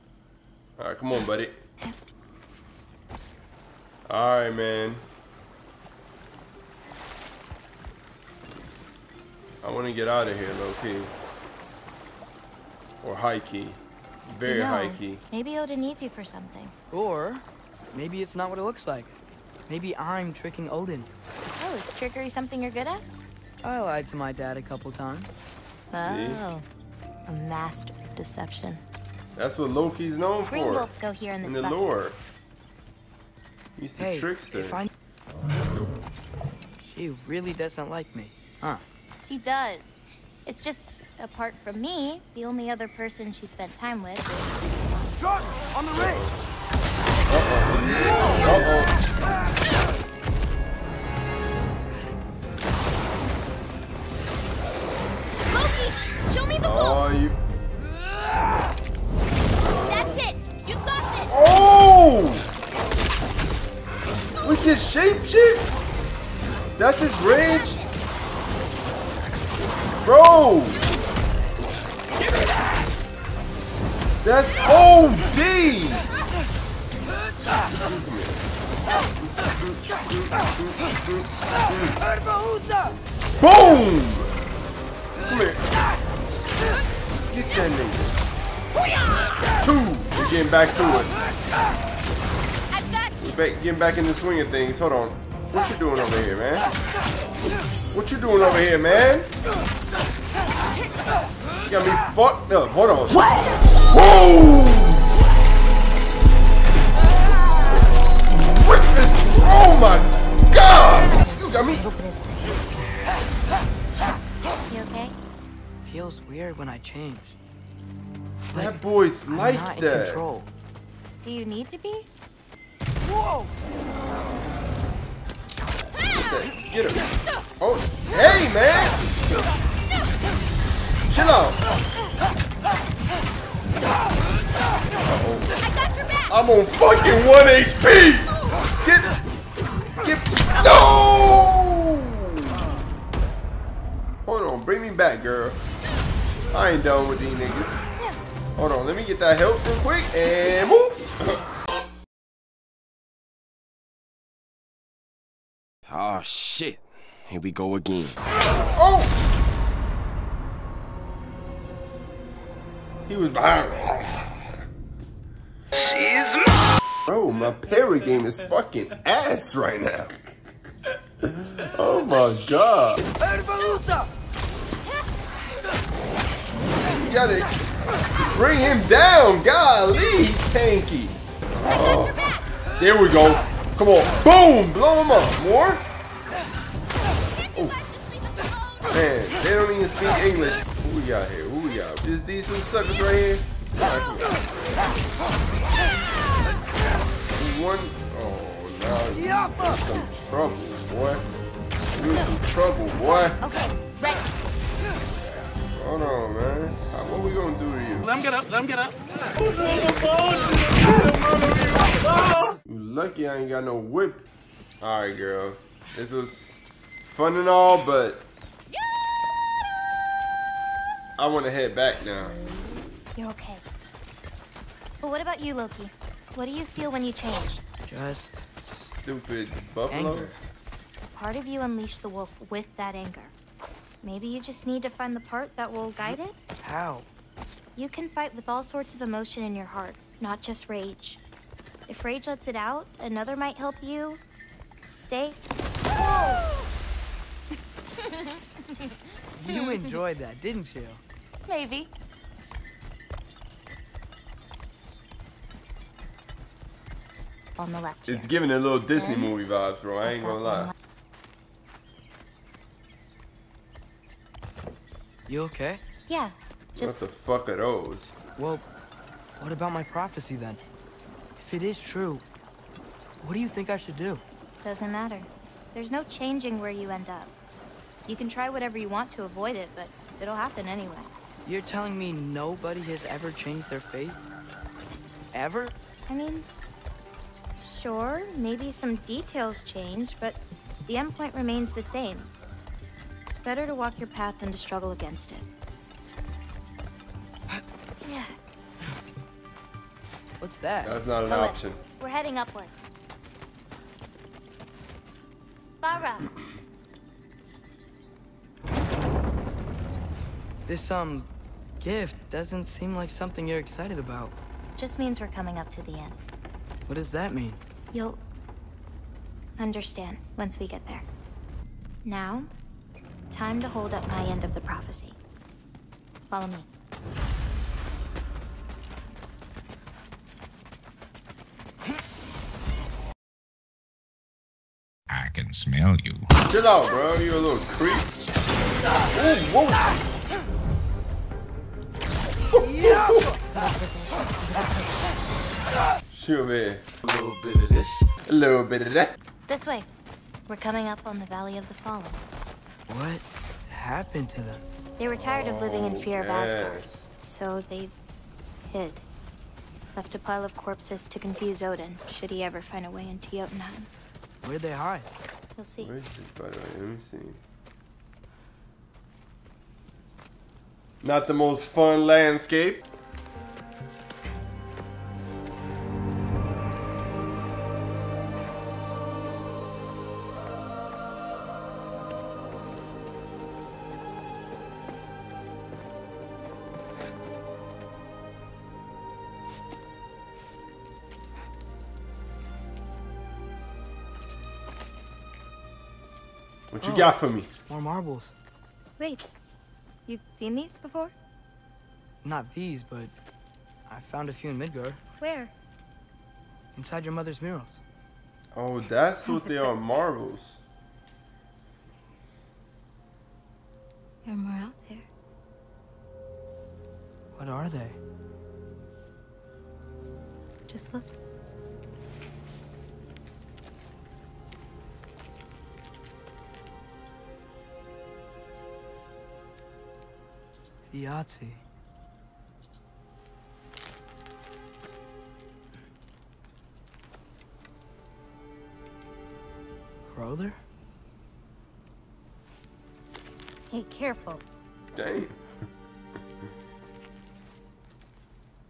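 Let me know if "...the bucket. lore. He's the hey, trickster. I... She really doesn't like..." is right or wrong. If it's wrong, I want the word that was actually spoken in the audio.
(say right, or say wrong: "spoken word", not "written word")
right.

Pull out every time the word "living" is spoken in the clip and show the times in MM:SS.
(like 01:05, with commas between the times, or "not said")
05:55.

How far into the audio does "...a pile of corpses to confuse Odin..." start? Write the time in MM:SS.
06:00.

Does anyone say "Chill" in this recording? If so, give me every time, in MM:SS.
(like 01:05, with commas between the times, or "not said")
02:09, 05:36.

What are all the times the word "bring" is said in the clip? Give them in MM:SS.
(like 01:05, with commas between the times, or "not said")
02:24, 02:58.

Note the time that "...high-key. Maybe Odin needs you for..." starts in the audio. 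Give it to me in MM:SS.
00:14.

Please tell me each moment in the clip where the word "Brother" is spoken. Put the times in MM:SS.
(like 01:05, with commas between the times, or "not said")
07:20.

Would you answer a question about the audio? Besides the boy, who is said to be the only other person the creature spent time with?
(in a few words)
Josh.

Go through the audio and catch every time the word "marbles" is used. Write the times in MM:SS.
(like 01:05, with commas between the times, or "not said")
06:37, 06:49.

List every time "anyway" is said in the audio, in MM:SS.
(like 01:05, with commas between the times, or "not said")
04:40.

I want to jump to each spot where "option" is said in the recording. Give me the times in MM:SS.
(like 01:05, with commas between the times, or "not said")
05:01.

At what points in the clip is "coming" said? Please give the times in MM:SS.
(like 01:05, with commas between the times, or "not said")
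05:15, 05:50.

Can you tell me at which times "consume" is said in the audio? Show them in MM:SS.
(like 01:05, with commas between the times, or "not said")
not said.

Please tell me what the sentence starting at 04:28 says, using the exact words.
Well, what about my prophecy then?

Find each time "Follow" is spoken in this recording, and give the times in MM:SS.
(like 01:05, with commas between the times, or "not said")
05:26.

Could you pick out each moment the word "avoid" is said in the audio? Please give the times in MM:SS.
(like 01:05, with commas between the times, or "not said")
04:39.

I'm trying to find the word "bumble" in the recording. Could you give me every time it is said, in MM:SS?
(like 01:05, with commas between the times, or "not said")
not said.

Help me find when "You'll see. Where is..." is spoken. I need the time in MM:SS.
06:05.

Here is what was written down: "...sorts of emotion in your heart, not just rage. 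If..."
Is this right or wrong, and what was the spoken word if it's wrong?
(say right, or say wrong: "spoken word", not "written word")
right.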